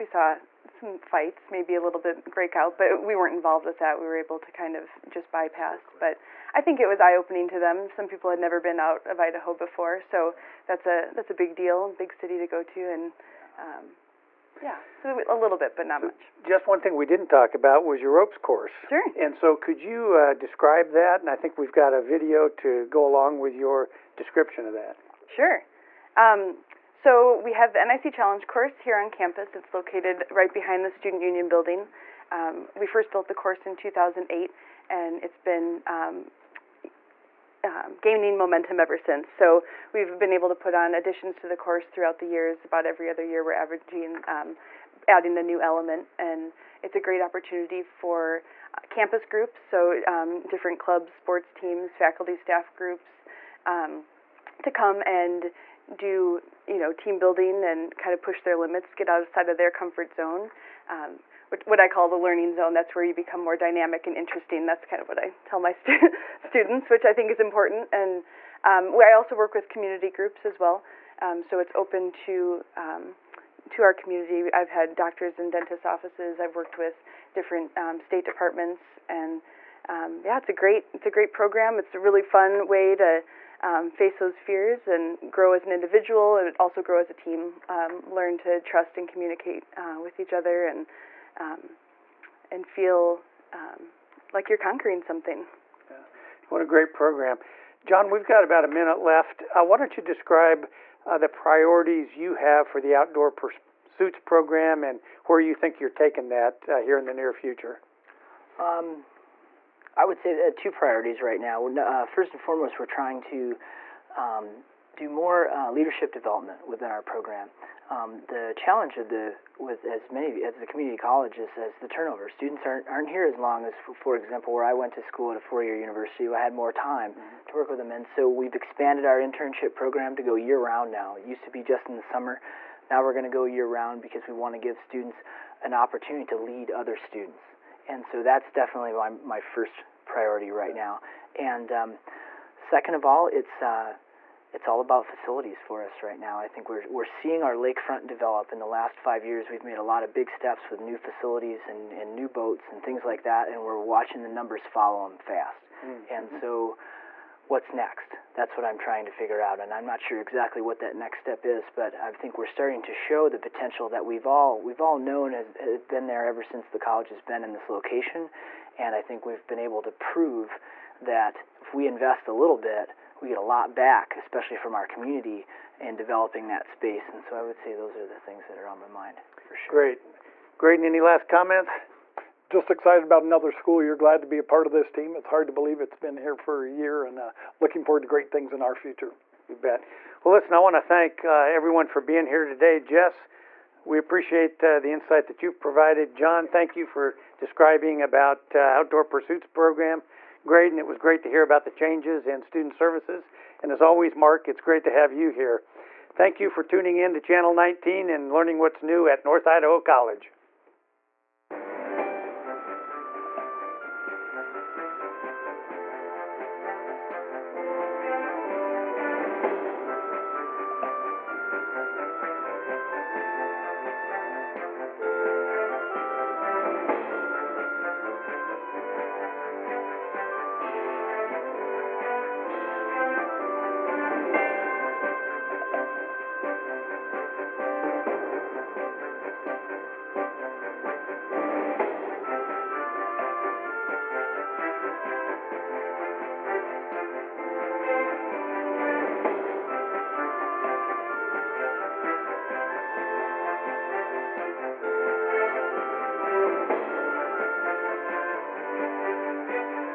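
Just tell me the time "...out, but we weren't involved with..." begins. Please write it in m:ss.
0:02.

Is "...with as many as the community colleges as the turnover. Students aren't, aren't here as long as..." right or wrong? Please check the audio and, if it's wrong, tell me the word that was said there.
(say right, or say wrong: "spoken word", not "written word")
right.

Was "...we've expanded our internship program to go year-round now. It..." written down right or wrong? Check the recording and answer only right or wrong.
right.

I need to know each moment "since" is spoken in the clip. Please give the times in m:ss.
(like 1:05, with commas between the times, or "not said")
0:38, 2:46.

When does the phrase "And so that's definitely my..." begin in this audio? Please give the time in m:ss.
2:17.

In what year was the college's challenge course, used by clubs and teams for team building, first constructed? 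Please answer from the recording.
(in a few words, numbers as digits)
2008.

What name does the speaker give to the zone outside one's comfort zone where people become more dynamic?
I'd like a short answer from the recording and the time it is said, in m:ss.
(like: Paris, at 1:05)
learning zone, at 1:02.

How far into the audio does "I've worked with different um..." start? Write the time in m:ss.
1:16.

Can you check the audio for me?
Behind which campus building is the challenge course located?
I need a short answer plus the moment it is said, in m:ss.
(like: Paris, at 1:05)
Student Union building, at 0:30.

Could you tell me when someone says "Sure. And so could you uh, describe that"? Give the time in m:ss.
0:18.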